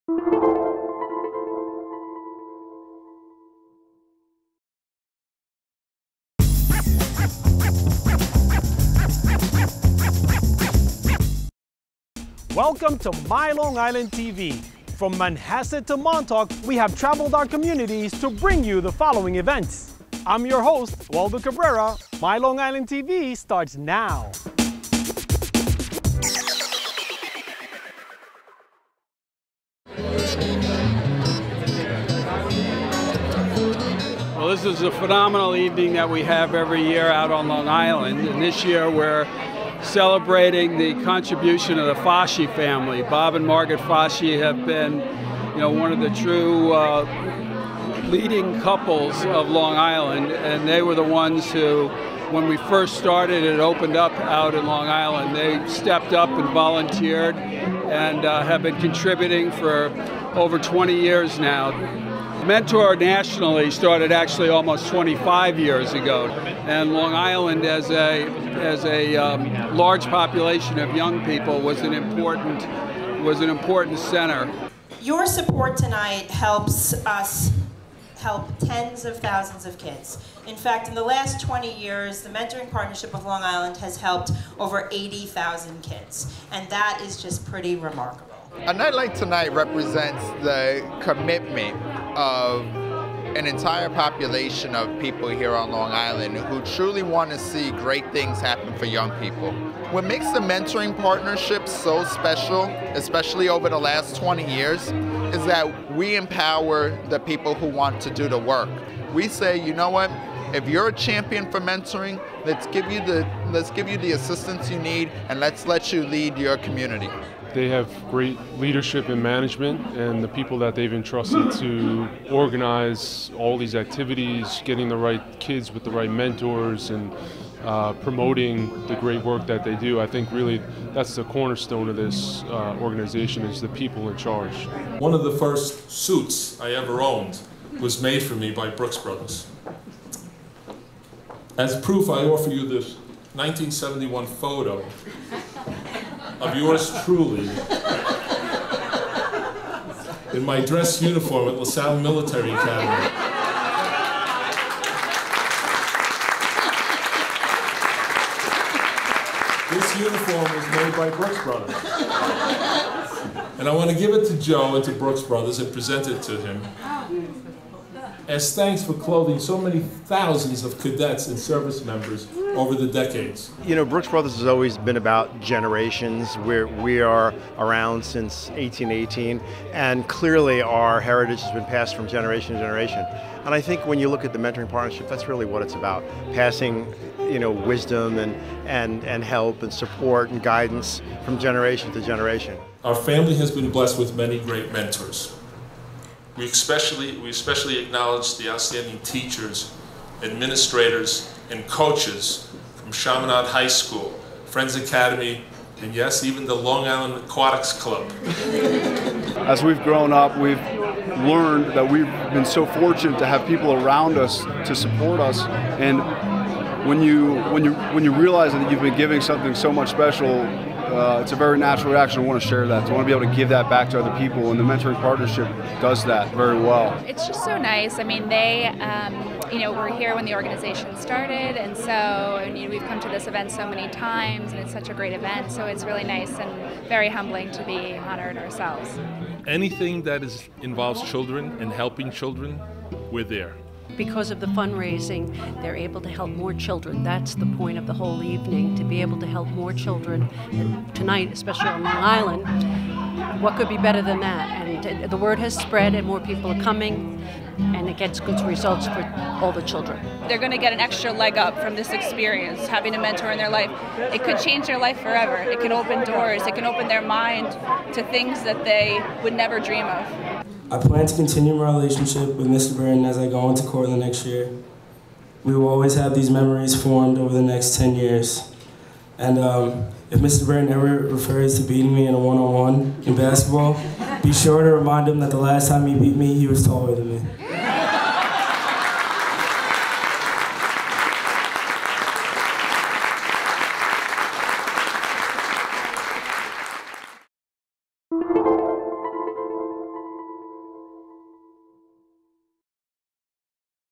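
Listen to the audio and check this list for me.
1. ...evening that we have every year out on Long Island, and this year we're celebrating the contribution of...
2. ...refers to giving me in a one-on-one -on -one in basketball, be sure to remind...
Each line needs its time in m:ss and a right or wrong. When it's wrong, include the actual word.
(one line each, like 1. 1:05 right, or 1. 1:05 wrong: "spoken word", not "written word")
1. 0:35 right
2. 4:40 wrong: "beating", not "giving".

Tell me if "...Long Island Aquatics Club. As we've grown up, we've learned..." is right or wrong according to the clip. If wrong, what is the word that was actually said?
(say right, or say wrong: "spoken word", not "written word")
right.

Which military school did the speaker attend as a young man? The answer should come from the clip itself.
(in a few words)
LaSalle Military Academy.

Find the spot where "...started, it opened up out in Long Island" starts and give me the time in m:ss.
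0:52.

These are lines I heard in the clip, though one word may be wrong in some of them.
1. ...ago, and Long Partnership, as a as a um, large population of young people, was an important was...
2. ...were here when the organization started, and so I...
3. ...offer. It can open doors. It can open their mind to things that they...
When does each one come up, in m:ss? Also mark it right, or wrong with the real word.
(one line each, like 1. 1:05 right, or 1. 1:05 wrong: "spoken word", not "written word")
1. 1:05 wrong: "Island", not "Partnership"
2. 3:49 right
3. 4:24 wrong: "forever", not "offer".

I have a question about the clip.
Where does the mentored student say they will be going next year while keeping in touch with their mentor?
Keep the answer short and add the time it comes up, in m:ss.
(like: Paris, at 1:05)
Cortland, at 4:33.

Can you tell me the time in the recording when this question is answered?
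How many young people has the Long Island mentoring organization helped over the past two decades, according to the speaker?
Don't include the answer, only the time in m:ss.
1:24.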